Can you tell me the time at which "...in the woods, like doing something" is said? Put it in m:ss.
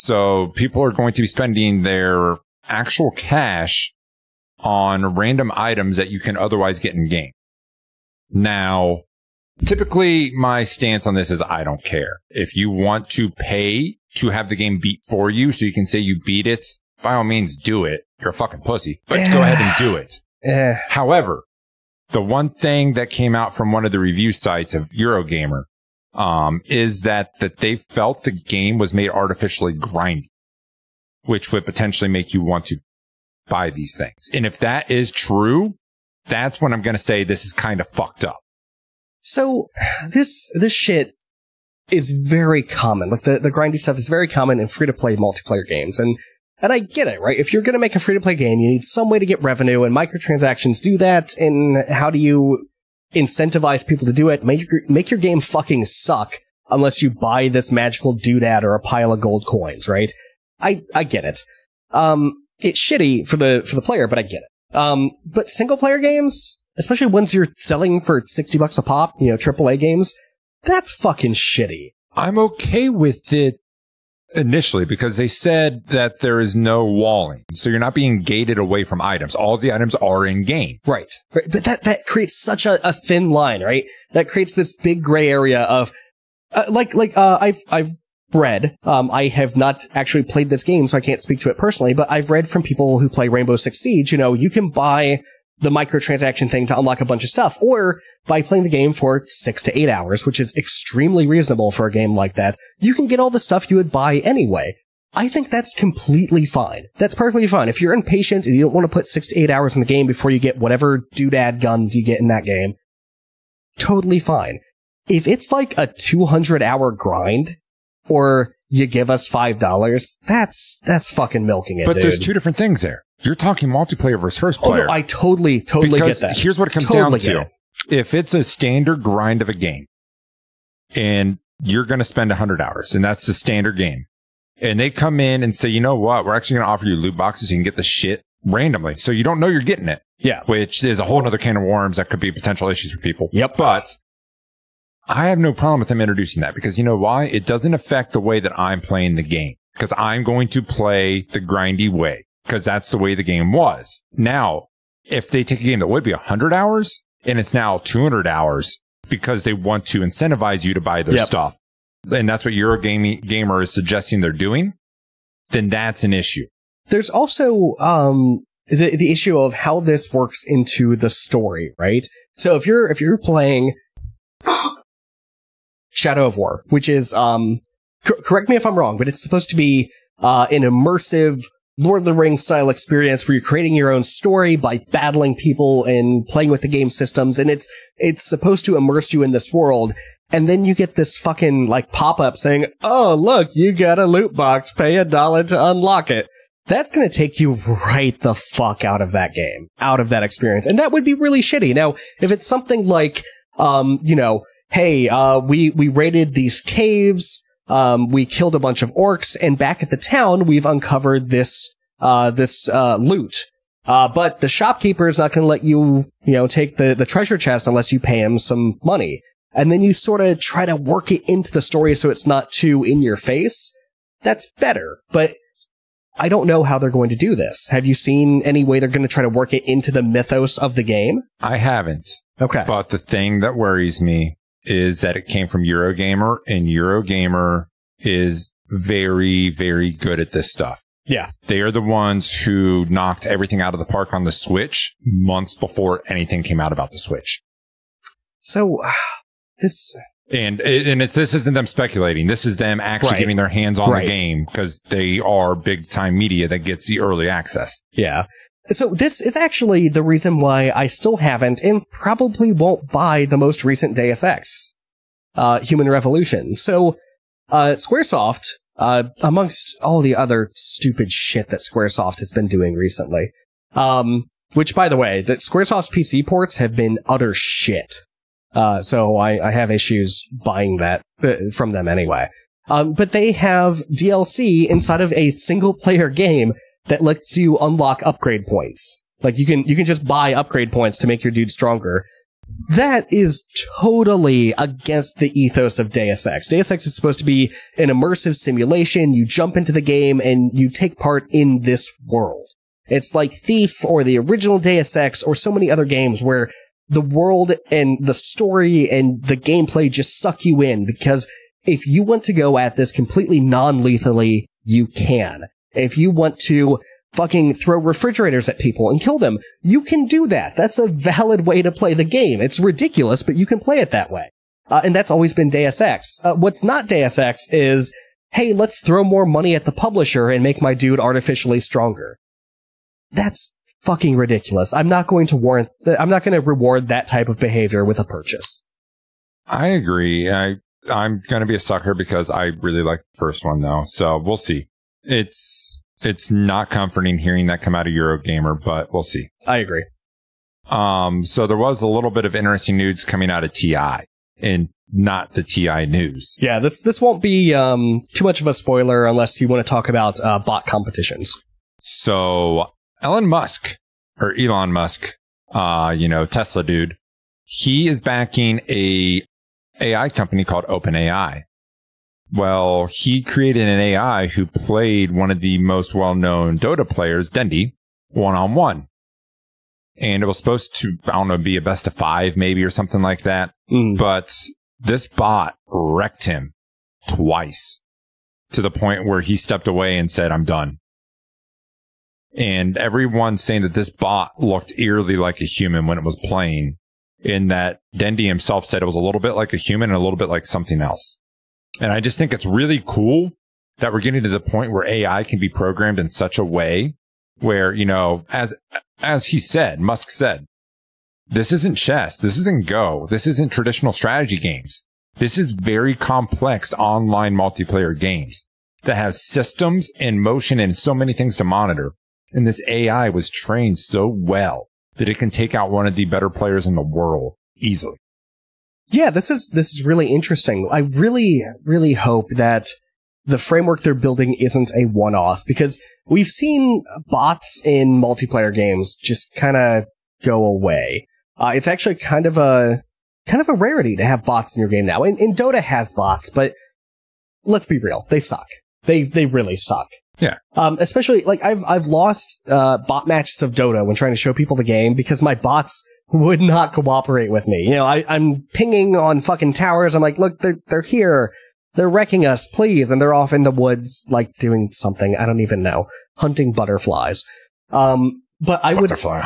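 7:43.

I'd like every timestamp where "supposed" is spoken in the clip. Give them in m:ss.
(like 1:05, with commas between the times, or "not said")
2:59, 3:08, 4:56, 6:20.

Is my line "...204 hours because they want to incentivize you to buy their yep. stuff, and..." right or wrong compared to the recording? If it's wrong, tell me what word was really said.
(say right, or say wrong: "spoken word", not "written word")
wrong: "200", not "204".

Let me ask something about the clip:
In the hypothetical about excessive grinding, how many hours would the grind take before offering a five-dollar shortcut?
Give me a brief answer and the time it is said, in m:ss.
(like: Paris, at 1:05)
200 hours, at 1:55.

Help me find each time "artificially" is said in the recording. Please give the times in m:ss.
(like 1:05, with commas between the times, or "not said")
0:29, 5:30.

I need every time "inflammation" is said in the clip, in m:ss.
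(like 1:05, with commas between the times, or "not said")
not said.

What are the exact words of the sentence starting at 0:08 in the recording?
Now, typically my stance on this is I don't care.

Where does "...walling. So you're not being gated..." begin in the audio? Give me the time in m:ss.
1:16.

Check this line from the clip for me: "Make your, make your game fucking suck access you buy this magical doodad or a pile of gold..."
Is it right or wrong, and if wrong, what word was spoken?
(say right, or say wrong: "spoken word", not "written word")
wrong: "unless", not "access".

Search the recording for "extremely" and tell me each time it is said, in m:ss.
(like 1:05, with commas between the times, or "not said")
1:40.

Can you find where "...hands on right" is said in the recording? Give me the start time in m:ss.
4:13.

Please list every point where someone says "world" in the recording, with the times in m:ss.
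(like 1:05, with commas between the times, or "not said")
3:09, 5:02, 5:07, 7:06.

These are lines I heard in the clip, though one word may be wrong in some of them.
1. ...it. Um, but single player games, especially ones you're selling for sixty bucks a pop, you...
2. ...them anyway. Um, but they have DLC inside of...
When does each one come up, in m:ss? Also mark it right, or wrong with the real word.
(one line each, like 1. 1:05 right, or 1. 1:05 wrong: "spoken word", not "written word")
1. 1:04 right
2. 4:41 right.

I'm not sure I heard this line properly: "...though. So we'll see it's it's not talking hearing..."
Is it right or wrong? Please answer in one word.
wrong.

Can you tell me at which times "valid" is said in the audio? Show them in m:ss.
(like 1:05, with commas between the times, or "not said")
5:20.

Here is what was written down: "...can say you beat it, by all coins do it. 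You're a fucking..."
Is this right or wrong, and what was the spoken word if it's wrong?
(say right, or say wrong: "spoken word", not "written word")
wrong: "means", not "coins".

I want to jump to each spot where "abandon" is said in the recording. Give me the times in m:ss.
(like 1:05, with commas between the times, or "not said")
not said.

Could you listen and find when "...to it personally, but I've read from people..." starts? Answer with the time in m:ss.
1:31.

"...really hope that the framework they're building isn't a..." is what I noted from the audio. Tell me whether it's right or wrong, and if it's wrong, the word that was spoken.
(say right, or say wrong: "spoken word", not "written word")
right.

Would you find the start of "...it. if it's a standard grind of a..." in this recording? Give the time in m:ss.
2:07.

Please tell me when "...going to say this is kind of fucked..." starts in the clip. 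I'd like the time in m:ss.
0:36.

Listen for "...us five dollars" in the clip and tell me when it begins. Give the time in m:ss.
1:59.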